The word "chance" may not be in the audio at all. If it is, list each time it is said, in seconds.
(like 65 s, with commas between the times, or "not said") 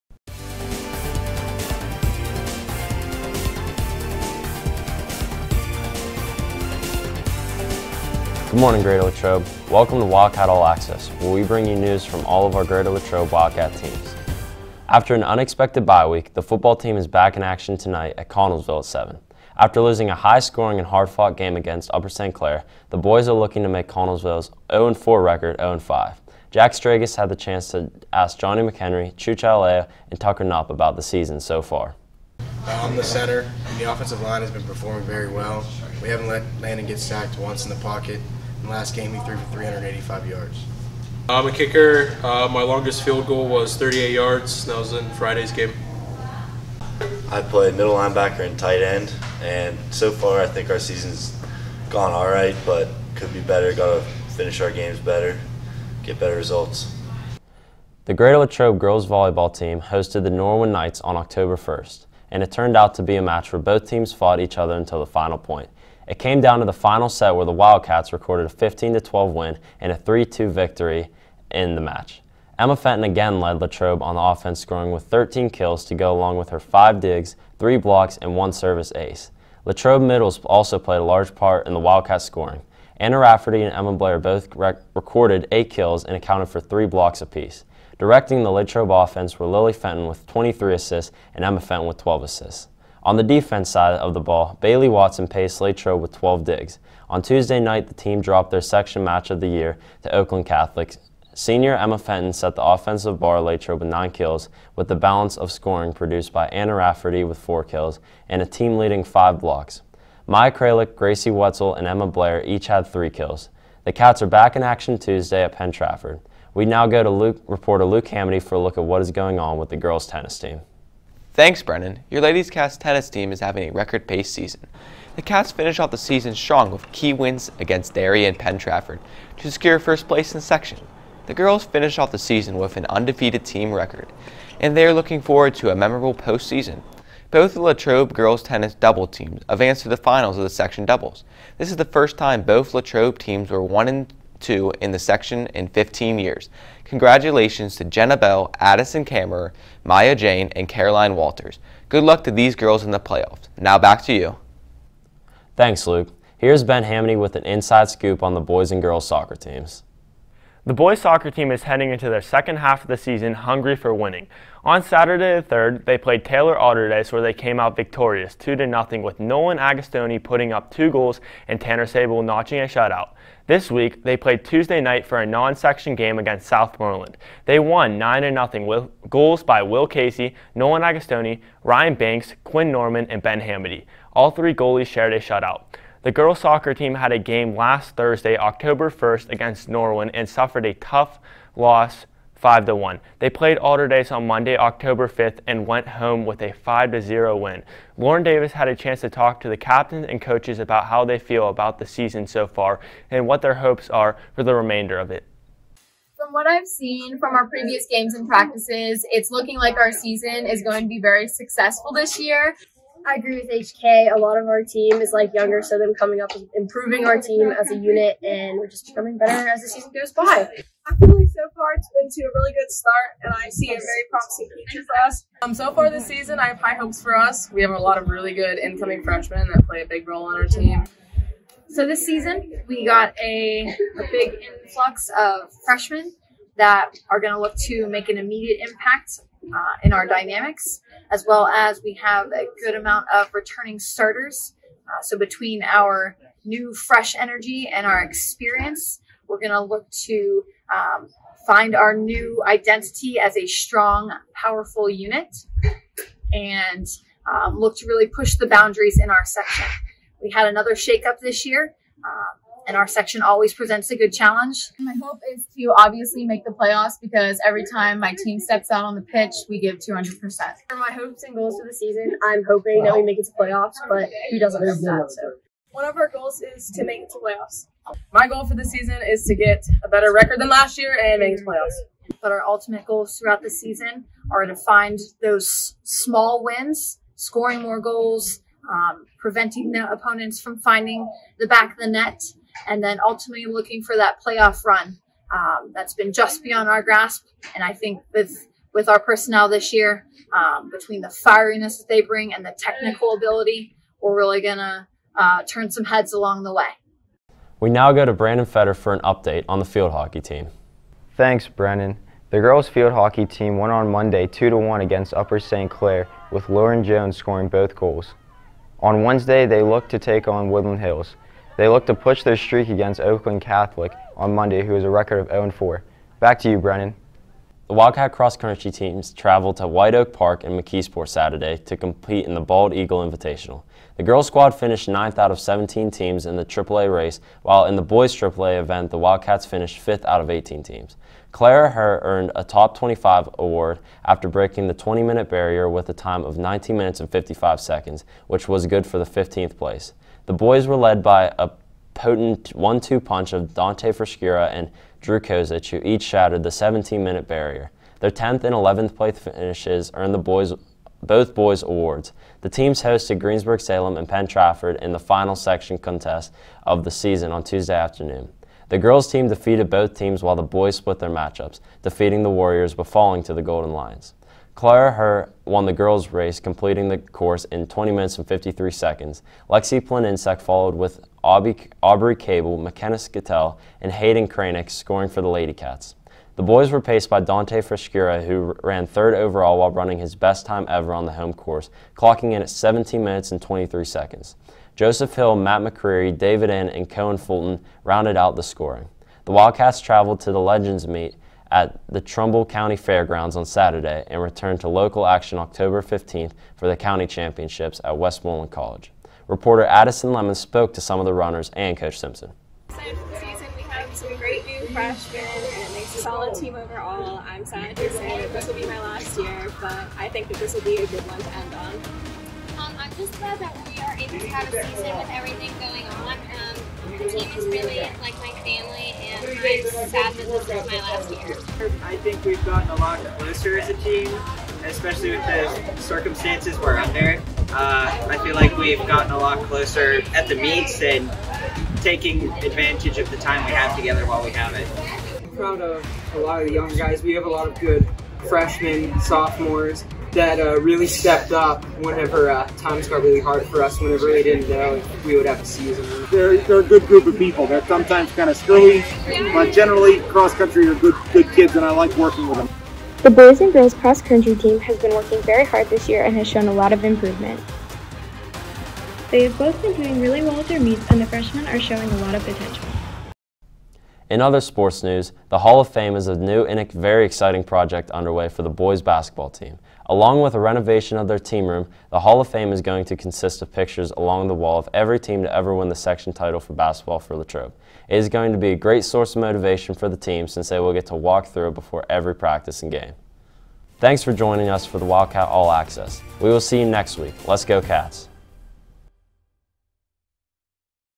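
27 s, 198 s.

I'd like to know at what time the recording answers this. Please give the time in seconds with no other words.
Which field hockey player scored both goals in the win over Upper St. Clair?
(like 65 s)
316 s.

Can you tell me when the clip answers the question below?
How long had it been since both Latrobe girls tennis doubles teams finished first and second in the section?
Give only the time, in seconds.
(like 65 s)
145 s.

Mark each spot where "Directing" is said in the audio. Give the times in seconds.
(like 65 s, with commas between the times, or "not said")
87 s.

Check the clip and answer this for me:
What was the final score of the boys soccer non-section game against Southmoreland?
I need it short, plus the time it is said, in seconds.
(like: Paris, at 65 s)
9-0, at 177 s.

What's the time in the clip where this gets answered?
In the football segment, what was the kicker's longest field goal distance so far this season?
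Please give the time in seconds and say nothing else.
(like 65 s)
43 s.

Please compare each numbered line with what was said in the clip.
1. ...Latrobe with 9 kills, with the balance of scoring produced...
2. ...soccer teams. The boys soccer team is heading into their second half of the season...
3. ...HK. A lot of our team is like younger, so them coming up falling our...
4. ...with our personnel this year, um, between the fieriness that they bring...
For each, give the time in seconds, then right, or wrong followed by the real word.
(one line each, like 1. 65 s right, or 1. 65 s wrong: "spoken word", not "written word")
1. 103 s right
2. 159 s right
3. 213 s wrong: "improving", not "falling"
4. 298 s right.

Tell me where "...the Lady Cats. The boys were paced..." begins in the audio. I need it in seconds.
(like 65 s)
385 s.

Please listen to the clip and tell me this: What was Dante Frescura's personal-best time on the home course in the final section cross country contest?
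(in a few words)
17:23.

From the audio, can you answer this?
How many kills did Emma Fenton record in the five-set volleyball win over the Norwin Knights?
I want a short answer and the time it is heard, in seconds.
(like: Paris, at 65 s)
13, at 75 s.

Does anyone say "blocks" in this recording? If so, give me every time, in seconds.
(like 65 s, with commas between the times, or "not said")
77 s, 86 s, 109 s.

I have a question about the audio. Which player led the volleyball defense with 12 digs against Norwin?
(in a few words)
Bailey Watson.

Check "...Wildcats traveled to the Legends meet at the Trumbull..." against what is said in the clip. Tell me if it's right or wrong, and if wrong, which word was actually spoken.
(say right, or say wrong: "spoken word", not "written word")
right.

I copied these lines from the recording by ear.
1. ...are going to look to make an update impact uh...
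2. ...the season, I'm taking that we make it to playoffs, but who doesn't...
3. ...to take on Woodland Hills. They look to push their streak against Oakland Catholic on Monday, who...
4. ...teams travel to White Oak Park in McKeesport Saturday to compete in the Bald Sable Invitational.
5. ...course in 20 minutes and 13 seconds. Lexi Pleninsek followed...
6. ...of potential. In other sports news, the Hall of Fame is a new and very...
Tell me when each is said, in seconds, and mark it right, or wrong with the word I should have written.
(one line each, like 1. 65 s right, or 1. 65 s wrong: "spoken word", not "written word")
1. 237 s wrong: "immediate", not "update"
2. 271 s wrong: "hoping", not "taking"
3. 319 s right
4. 328 s wrong: "Eagle", not "Sable"
5. 376 s wrong: "53", not "13"
6. 472 s right.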